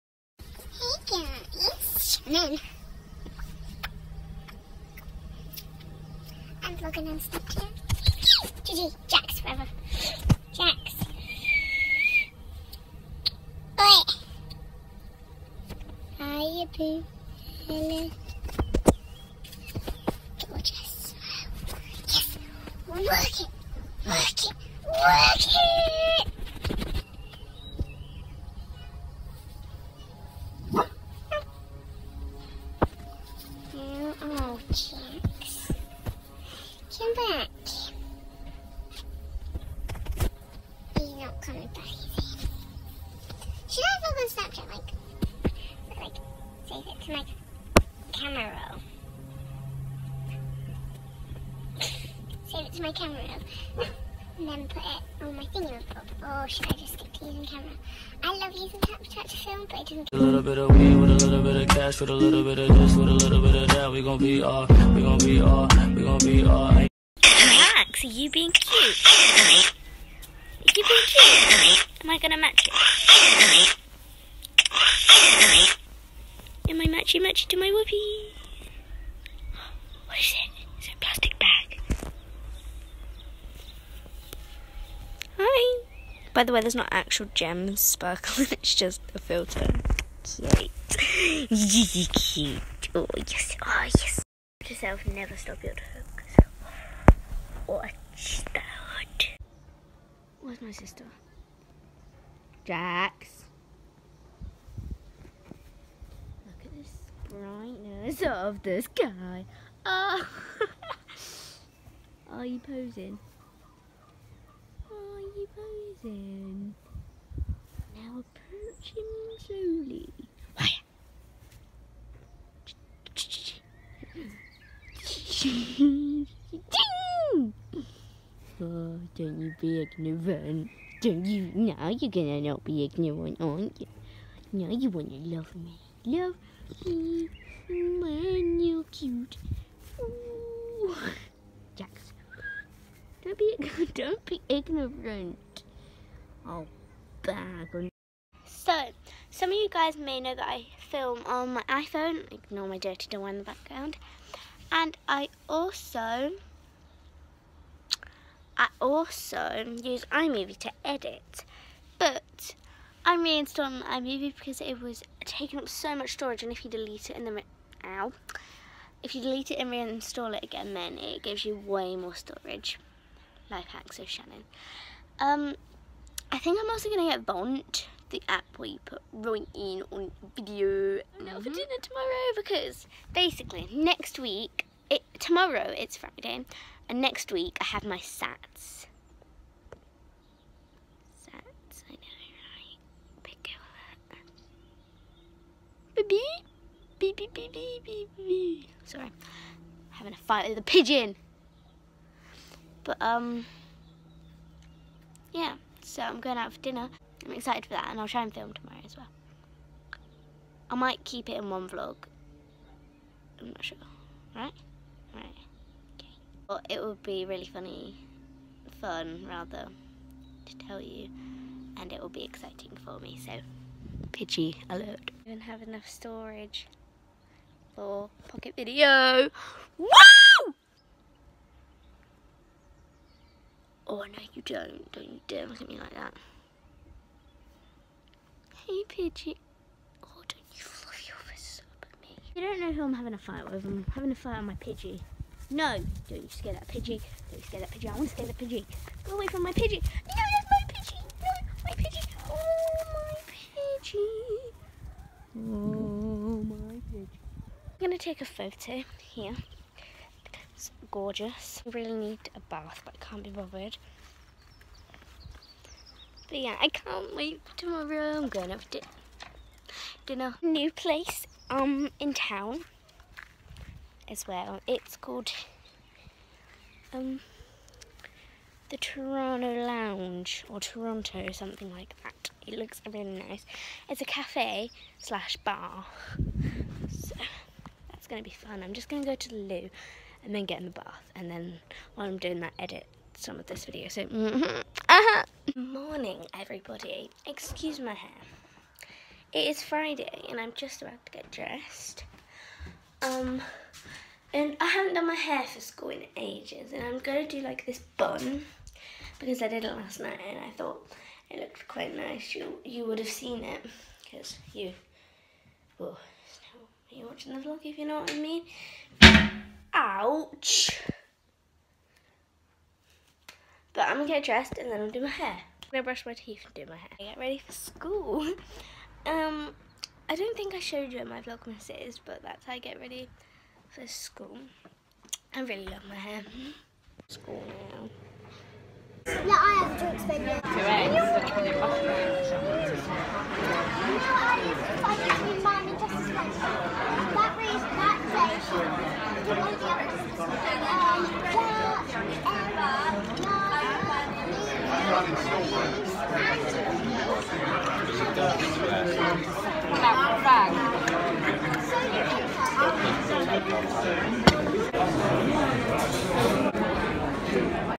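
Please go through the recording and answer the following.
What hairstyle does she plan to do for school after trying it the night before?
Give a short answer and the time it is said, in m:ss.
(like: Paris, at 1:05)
bun, at 5:07.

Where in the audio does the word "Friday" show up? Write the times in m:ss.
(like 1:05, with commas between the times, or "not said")
3:05, 4:59.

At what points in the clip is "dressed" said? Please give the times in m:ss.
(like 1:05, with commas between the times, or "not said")
5:01, 5:24.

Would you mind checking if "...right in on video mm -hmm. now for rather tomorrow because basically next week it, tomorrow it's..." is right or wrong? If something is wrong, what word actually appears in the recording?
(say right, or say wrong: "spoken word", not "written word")
wrong: "dinner", not "rather".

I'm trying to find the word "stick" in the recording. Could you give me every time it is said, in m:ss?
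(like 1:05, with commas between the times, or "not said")
0:56.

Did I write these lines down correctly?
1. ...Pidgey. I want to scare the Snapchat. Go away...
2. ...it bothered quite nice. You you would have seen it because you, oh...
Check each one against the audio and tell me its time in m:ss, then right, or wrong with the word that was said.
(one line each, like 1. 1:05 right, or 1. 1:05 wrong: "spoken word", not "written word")
1. 4:07 wrong: "Pidgey", not "Snapchat"
2. 5:11 wrong: "looked", not "bothered".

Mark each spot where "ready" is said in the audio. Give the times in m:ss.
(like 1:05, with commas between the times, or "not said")
5:27, 5:32.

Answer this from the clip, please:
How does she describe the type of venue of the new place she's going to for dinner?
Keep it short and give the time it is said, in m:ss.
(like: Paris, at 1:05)
cafe slash bar, at 4:44.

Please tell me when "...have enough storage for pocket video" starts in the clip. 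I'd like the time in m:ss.
3:45.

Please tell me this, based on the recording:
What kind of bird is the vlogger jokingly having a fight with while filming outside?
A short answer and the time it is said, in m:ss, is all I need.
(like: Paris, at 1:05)
pigeon, at 3:20.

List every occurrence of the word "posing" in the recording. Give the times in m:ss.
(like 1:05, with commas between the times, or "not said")
1:52.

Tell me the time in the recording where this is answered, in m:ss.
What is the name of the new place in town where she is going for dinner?
4:38.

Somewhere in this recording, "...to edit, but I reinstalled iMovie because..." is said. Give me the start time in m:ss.
2:40.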